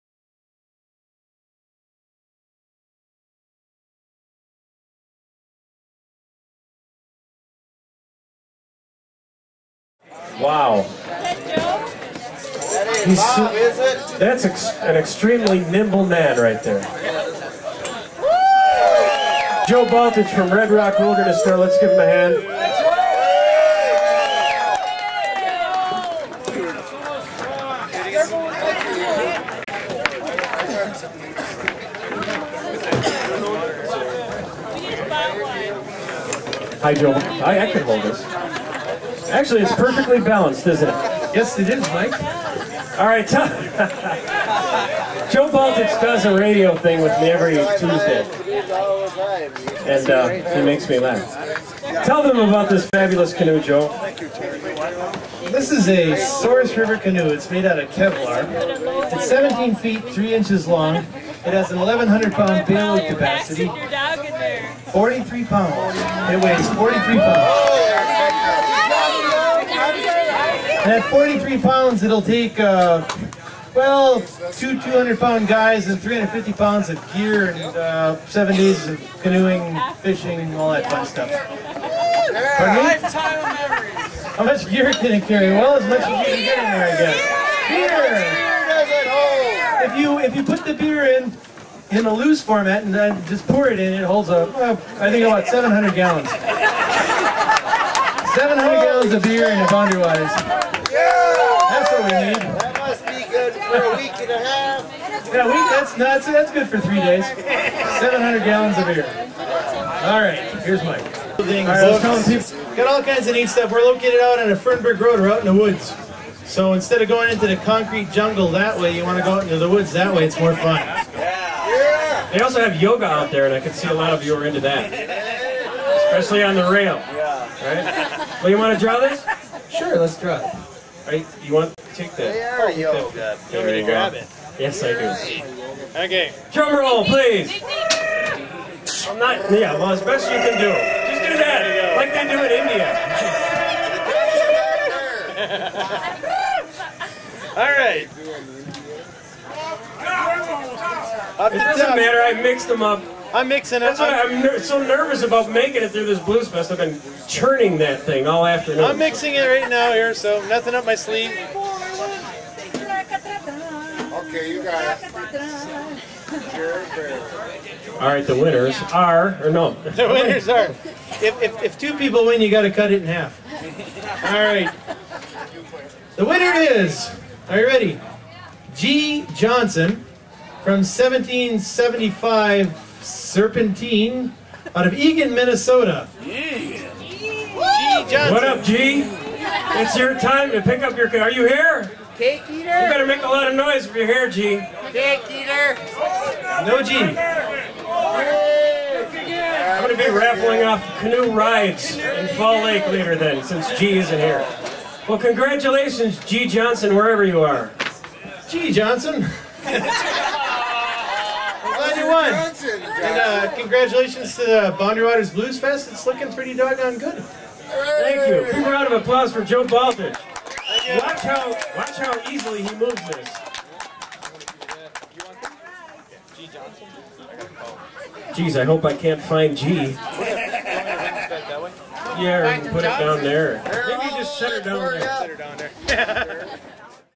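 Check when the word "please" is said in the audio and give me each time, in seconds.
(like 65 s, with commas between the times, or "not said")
137 s.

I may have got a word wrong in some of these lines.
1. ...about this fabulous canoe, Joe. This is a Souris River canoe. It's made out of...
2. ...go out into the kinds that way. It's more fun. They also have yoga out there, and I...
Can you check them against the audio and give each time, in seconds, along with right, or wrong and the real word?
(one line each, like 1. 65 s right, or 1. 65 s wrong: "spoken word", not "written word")
1. 52 s right
2. 119 s wrong: "woods", not "kinds".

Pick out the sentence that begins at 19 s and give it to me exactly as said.
Joe Baltich from Red Rock Wilderness Store.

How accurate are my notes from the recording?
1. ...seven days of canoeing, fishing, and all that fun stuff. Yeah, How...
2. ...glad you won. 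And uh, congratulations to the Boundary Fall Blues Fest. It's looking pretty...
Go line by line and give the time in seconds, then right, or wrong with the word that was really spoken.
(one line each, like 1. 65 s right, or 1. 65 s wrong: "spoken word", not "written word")
1. 78 s right
2. 209 s wrong: "Waters", not "Fall".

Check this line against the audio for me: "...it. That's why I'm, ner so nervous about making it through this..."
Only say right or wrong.
right.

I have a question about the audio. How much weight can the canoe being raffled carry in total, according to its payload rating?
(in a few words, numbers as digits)
1,100 pounds.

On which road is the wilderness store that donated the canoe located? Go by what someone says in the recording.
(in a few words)
Fernberg Road.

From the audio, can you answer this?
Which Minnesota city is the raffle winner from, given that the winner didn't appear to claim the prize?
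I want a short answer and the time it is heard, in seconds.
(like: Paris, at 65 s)
Eagan, at 184 s.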